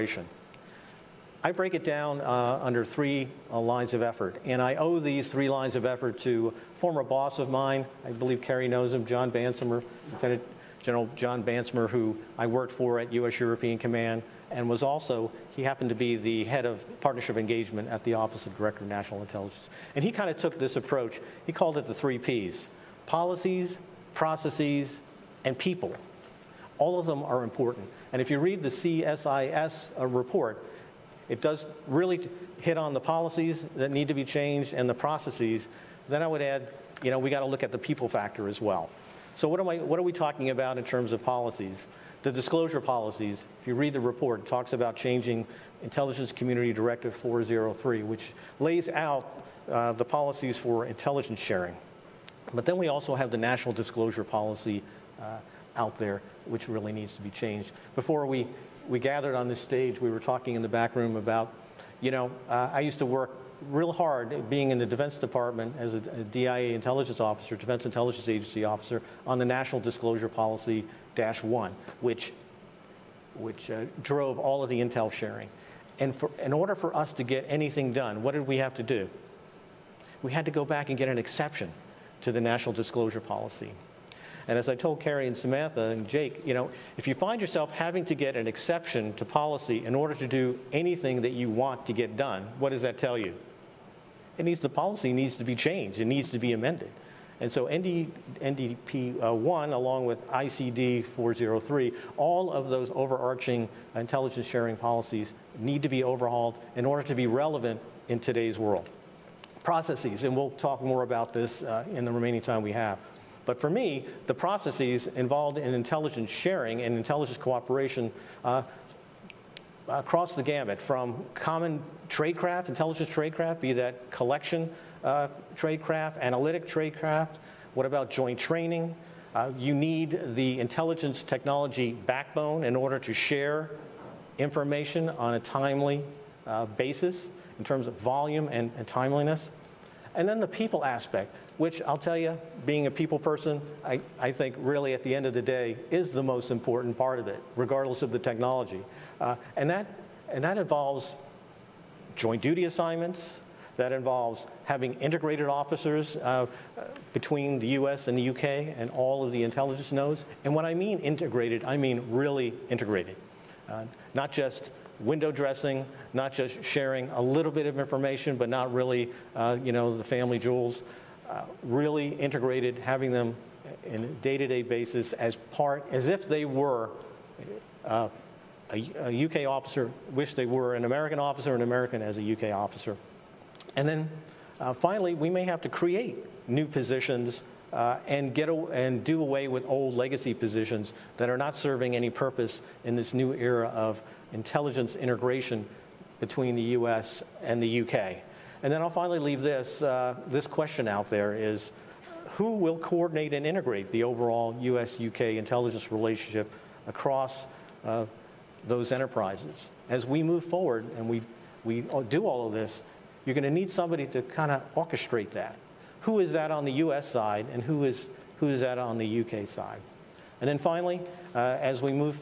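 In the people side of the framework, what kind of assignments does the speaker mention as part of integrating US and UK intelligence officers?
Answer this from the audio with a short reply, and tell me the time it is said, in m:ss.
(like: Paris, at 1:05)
joint duty assignments, at 2:32.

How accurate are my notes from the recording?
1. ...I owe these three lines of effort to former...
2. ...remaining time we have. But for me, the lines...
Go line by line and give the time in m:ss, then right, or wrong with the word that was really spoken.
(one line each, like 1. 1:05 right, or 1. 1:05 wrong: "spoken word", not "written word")
1. 0:04 right
2. 1:52 wrong: "processes", not "lines".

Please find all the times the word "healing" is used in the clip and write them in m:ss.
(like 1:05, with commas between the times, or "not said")
not said.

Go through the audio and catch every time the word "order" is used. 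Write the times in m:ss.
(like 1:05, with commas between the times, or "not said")
1:16, 1:29, 1:46, 2:12.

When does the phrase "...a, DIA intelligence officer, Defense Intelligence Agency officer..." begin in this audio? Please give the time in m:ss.
1:05.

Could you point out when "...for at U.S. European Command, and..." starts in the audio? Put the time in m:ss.
0:12.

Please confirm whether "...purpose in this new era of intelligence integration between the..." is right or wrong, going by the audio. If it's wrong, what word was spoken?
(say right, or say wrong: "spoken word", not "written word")
right.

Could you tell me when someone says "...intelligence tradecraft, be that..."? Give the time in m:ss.
2:02.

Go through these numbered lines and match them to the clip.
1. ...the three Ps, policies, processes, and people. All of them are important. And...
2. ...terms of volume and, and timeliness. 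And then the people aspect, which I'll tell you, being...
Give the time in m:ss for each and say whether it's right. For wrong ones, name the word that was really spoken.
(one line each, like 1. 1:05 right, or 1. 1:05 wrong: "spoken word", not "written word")
1. 0:21 right
2. 2:17 right.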